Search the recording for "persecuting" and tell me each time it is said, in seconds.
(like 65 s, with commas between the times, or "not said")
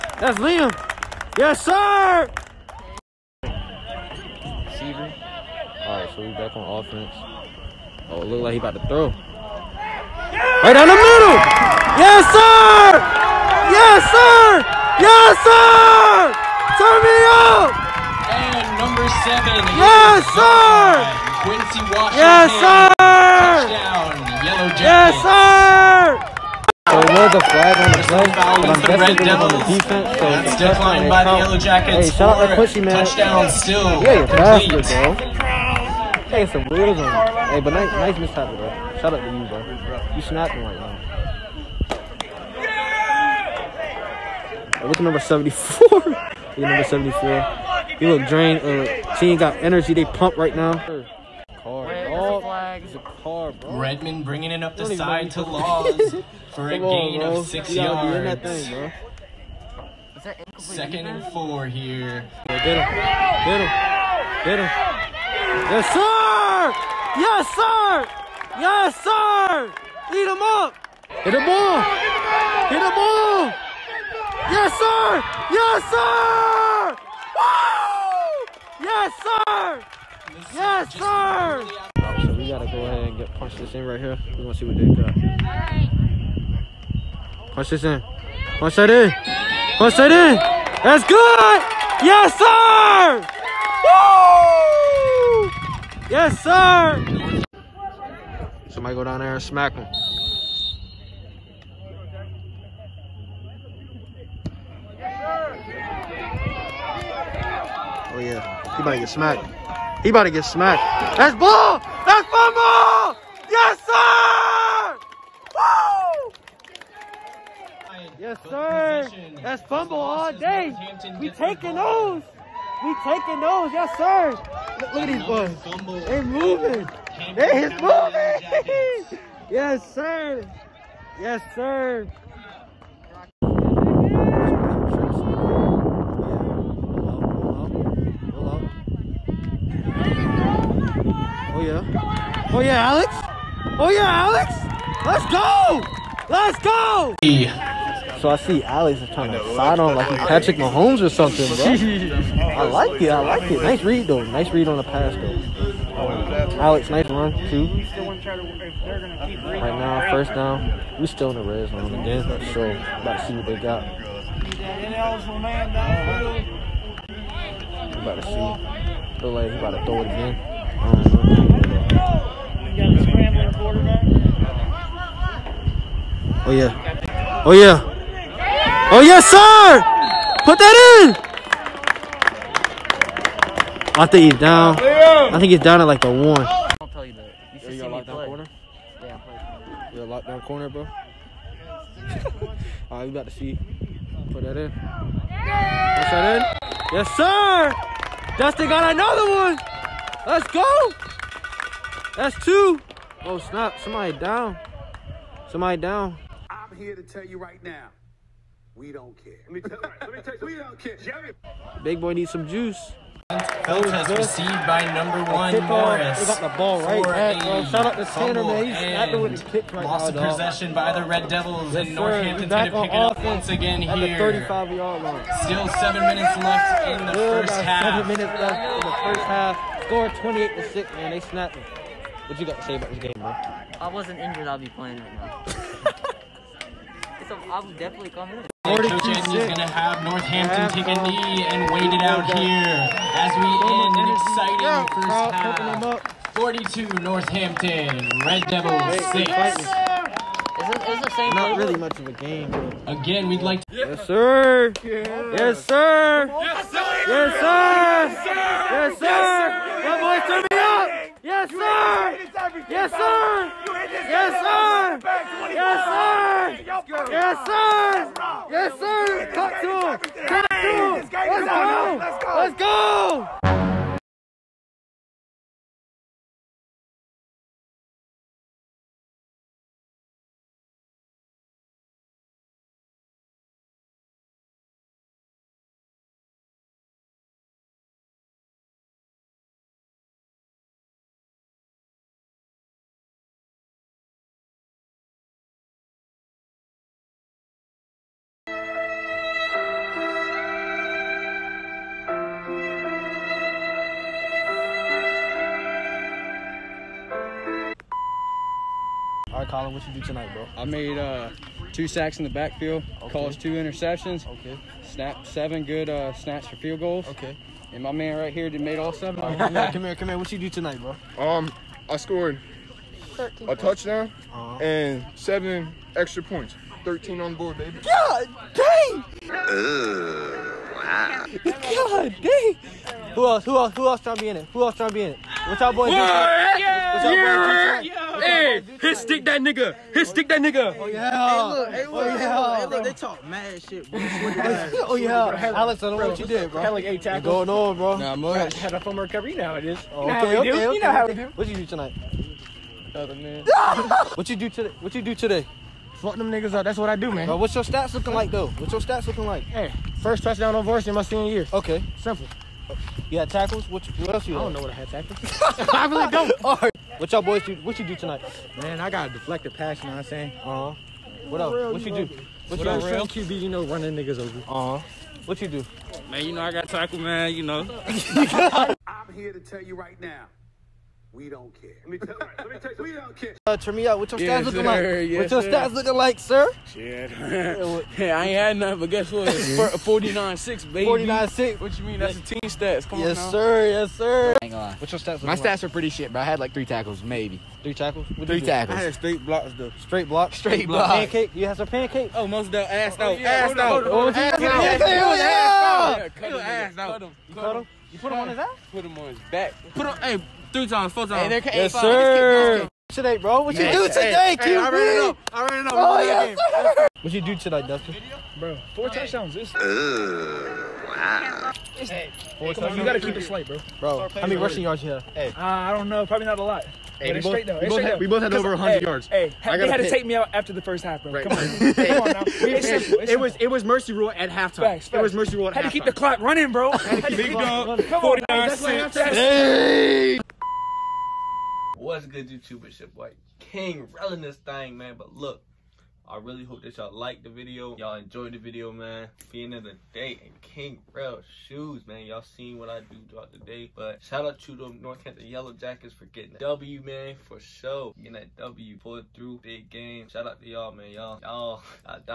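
not said.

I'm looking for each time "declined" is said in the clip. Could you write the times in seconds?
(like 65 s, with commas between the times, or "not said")
30 s.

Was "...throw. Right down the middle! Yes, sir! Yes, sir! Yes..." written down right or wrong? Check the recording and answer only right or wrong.
right.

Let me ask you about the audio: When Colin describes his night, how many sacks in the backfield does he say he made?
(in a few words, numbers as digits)
2.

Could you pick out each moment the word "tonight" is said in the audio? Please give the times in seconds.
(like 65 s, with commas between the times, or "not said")
310 s, 320 s, 351 s, 367 s, 417 s.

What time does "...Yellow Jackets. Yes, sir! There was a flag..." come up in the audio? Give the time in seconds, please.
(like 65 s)
24 s.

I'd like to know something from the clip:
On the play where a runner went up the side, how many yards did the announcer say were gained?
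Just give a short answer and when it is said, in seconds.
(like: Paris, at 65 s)
6, at 57 s.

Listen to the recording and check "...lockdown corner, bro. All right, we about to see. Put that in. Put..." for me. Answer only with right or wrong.
right.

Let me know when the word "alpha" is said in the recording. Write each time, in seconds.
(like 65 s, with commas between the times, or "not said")
not said.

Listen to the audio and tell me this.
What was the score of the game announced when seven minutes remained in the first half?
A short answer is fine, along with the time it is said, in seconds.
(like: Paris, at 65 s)
28 to 6, at 230 s.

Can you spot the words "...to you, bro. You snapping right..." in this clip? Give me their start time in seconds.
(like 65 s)
39 s.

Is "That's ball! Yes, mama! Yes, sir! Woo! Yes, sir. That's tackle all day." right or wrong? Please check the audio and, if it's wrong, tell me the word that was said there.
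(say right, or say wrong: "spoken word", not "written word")
wrong: "fumble", not "tackle".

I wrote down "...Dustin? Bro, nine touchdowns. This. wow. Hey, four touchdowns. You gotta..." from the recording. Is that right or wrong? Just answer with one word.
wrong.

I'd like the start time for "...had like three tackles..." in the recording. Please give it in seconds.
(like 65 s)
396 s.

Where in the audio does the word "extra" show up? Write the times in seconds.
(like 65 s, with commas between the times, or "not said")
325 s.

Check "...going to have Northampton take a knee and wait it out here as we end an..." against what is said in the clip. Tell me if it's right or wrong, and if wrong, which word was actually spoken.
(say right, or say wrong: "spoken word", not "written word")
right.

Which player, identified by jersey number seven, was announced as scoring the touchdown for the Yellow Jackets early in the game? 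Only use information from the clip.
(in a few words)
Quincy Washington.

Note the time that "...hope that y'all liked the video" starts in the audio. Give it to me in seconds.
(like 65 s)
446 s.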